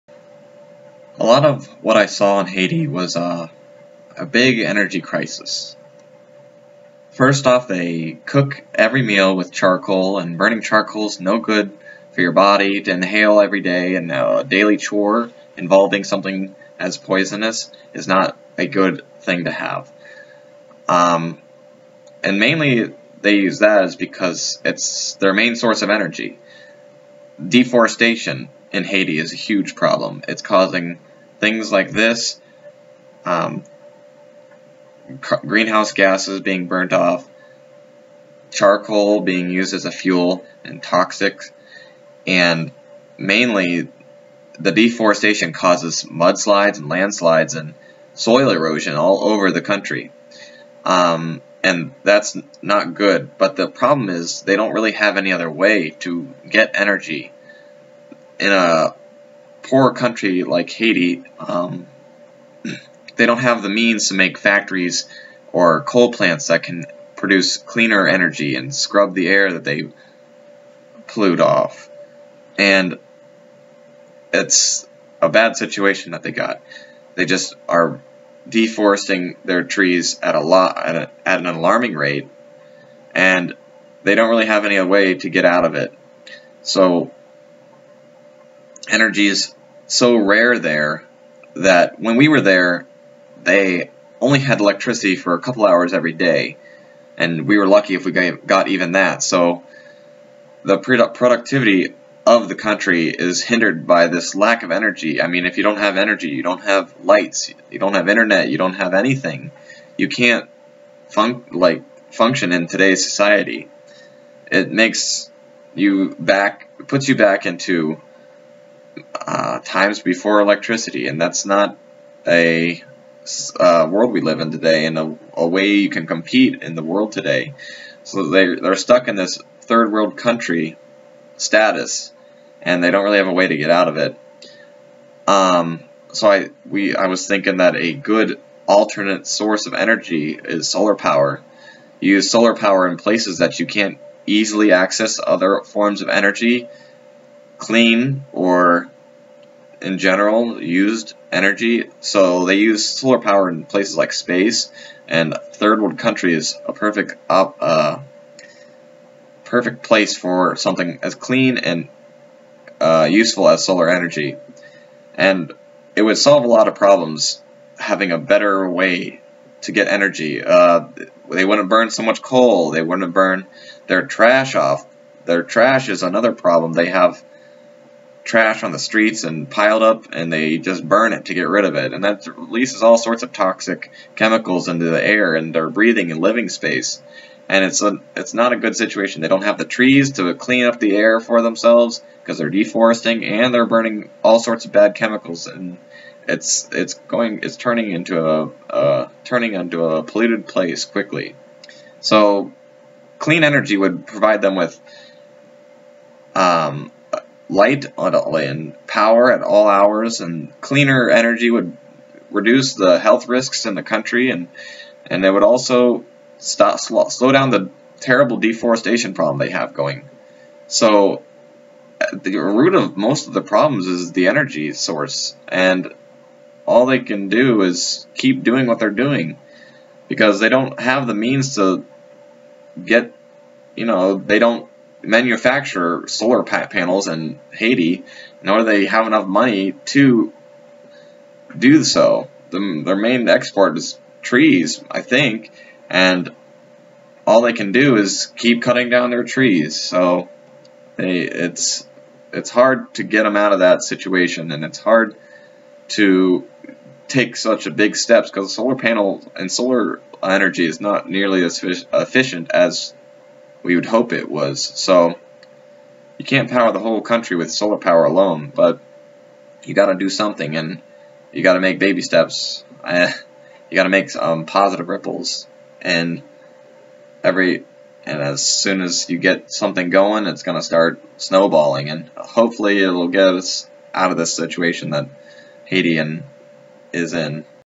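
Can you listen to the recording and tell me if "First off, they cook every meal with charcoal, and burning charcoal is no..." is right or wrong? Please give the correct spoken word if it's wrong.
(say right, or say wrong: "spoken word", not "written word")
right.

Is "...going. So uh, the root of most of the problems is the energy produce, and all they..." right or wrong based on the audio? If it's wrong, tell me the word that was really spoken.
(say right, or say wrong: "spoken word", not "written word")
wrong: "source", not "produce".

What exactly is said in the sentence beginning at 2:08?
So they, they're stuck in this third world country status, and they don't really have a way to get out of it.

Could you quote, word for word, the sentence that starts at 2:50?
Uh, they wouldn't burn so much coal.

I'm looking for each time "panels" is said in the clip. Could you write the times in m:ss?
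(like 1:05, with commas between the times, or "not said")
3:56, 4:18.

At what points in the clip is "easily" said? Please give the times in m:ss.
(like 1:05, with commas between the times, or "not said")
2:24.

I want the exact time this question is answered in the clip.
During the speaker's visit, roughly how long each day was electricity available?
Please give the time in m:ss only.
1:35.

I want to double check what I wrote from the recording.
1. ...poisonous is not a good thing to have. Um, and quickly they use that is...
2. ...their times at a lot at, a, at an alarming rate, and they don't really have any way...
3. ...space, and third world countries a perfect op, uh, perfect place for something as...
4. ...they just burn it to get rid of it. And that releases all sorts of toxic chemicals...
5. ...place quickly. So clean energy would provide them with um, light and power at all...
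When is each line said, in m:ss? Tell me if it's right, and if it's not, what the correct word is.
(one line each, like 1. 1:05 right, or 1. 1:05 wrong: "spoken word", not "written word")
1. 0:16 wrong: "mainly", not "quickly"
2. 1:19 wrong: "trees", not "times"
3. 2:34 right
4. 3:00 right
5. 3:20 right.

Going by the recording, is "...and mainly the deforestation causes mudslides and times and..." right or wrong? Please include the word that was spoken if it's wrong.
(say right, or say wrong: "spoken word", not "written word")
wrong: "landslides", not "times".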